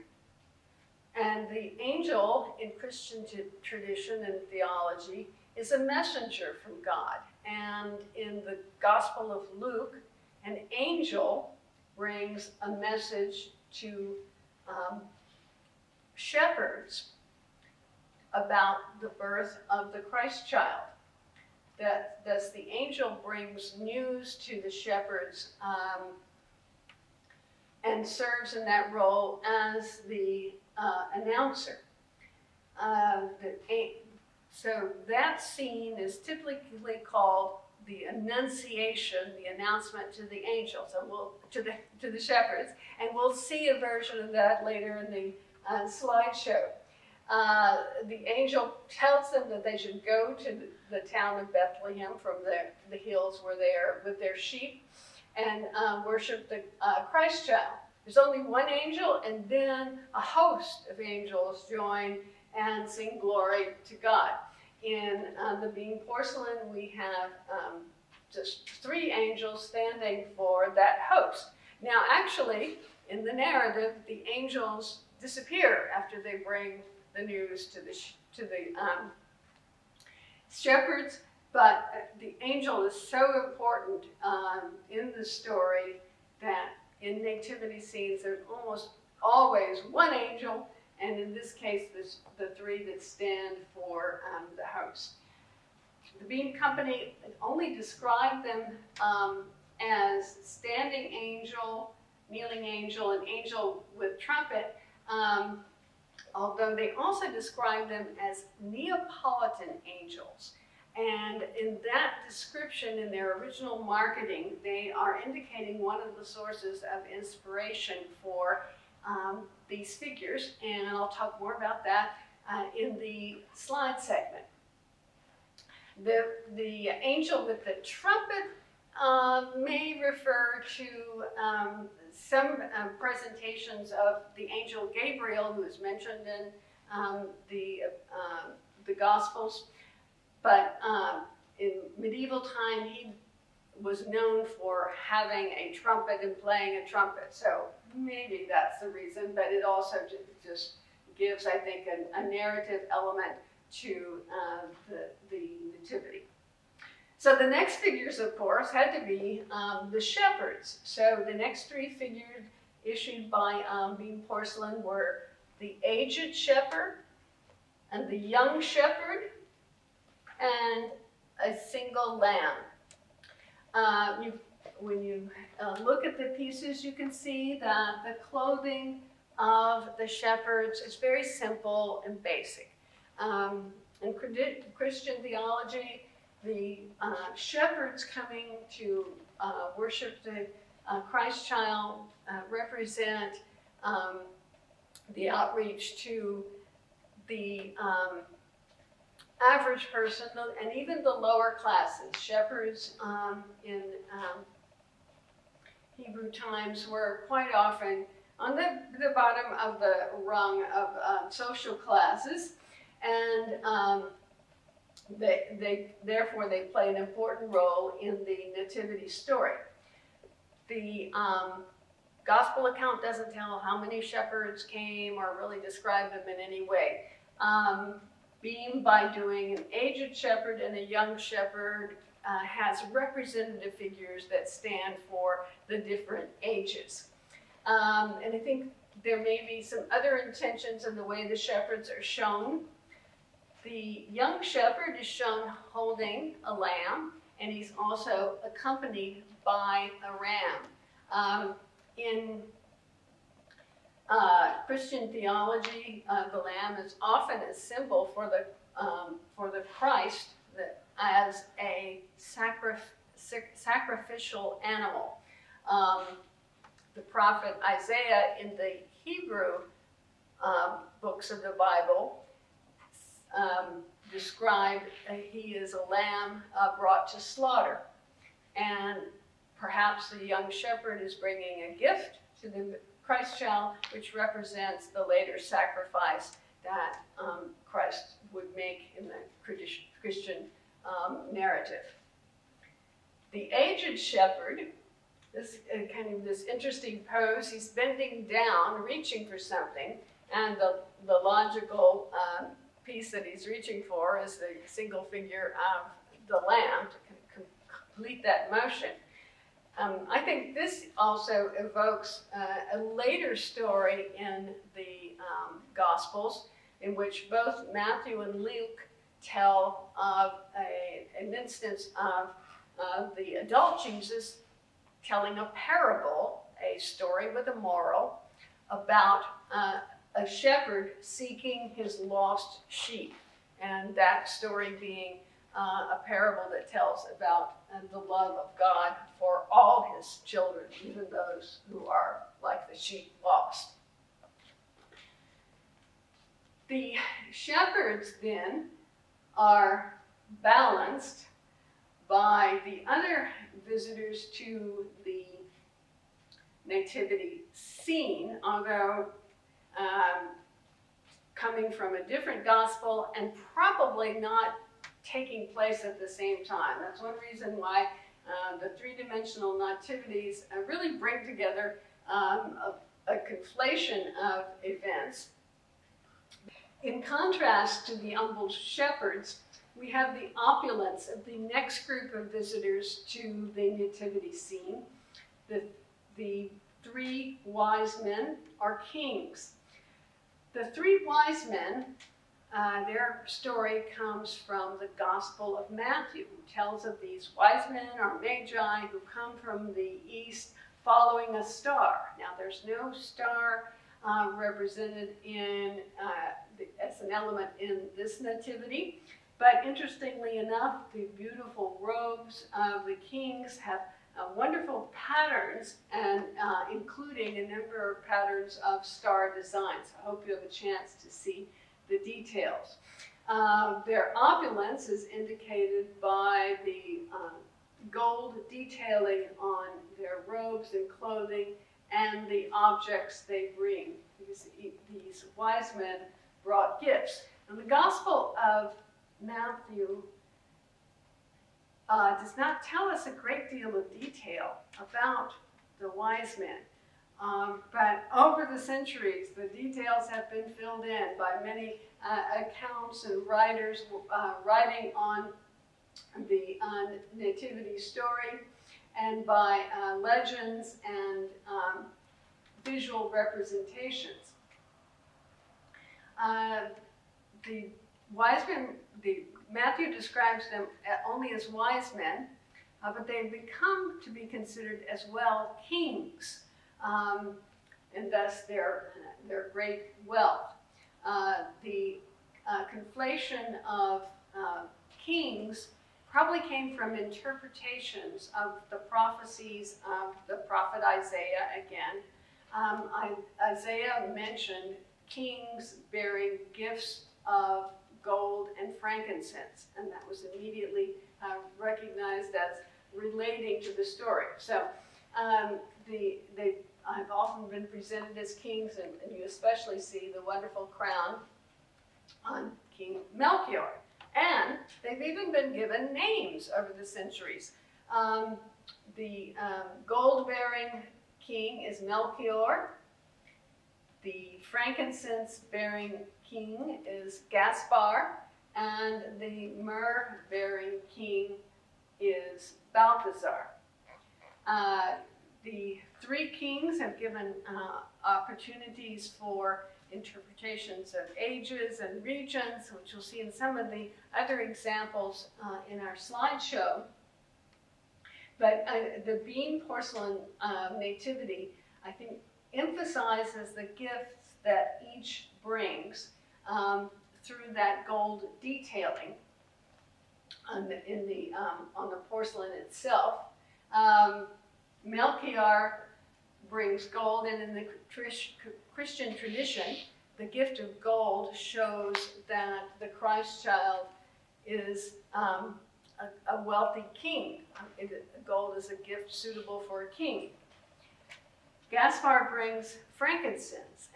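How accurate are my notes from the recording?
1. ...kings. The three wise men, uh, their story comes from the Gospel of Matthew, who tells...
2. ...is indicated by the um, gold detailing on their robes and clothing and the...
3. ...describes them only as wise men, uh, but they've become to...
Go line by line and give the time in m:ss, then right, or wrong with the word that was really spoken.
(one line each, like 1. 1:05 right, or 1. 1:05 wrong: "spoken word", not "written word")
1. 6:28 right
2. 7:04 right
3. 7:49 right.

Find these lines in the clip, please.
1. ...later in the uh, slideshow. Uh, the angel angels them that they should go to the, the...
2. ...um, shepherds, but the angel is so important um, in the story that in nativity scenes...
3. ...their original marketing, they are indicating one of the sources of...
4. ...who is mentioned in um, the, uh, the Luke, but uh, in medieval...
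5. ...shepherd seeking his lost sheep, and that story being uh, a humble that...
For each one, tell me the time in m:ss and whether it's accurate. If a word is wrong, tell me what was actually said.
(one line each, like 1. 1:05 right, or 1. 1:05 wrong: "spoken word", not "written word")
1. 0:44 wrong: "tells", not "angels"
2. 1:18 right
3. 1:53 right
4. 2:15 wrong: "Gospels", not "Luke"
5. 5:30 wrong: "parable", not "humble".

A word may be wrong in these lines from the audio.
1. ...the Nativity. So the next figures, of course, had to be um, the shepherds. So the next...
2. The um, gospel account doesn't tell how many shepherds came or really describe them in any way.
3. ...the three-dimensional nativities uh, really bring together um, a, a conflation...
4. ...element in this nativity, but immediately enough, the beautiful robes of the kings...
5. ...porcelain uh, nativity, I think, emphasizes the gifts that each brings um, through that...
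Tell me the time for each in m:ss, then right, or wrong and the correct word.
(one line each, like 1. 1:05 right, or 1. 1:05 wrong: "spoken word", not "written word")
1. 2:35 right
2. 3:40 right
3. 6:08 right
4. 6:47 wrong: "interestingly", not "immediately"
5. 9:09 right.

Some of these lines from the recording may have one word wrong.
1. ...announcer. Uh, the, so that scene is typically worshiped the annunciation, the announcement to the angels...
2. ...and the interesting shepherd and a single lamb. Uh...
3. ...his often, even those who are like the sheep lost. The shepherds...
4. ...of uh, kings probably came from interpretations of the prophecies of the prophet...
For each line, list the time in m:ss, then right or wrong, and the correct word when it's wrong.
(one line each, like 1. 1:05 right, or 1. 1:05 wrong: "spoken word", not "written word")
1. 0:31 wrong: "called", not "worshiped"
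2. 2:47 wrong: "young", not "interesting"
3. 5:39 wrong: "children", not "often"
4. 8:03 right.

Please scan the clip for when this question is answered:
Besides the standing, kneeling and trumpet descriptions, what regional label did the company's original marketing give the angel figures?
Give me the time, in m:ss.
1:48.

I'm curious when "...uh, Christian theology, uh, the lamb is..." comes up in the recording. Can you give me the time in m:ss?
4:14.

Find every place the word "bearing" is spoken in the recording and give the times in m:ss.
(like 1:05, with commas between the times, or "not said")
8:15, 8:39, 8:44, 8:50.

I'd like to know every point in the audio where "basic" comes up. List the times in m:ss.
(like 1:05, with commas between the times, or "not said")
3:02.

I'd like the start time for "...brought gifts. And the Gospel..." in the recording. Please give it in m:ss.
7:16.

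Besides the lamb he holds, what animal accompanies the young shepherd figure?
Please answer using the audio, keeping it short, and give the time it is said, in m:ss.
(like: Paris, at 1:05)
A ram, at 4:10.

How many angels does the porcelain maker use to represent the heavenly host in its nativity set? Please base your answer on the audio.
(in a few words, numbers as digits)
3.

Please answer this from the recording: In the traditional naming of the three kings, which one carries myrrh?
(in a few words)
Balthasar.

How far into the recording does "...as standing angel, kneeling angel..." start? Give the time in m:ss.
1:39.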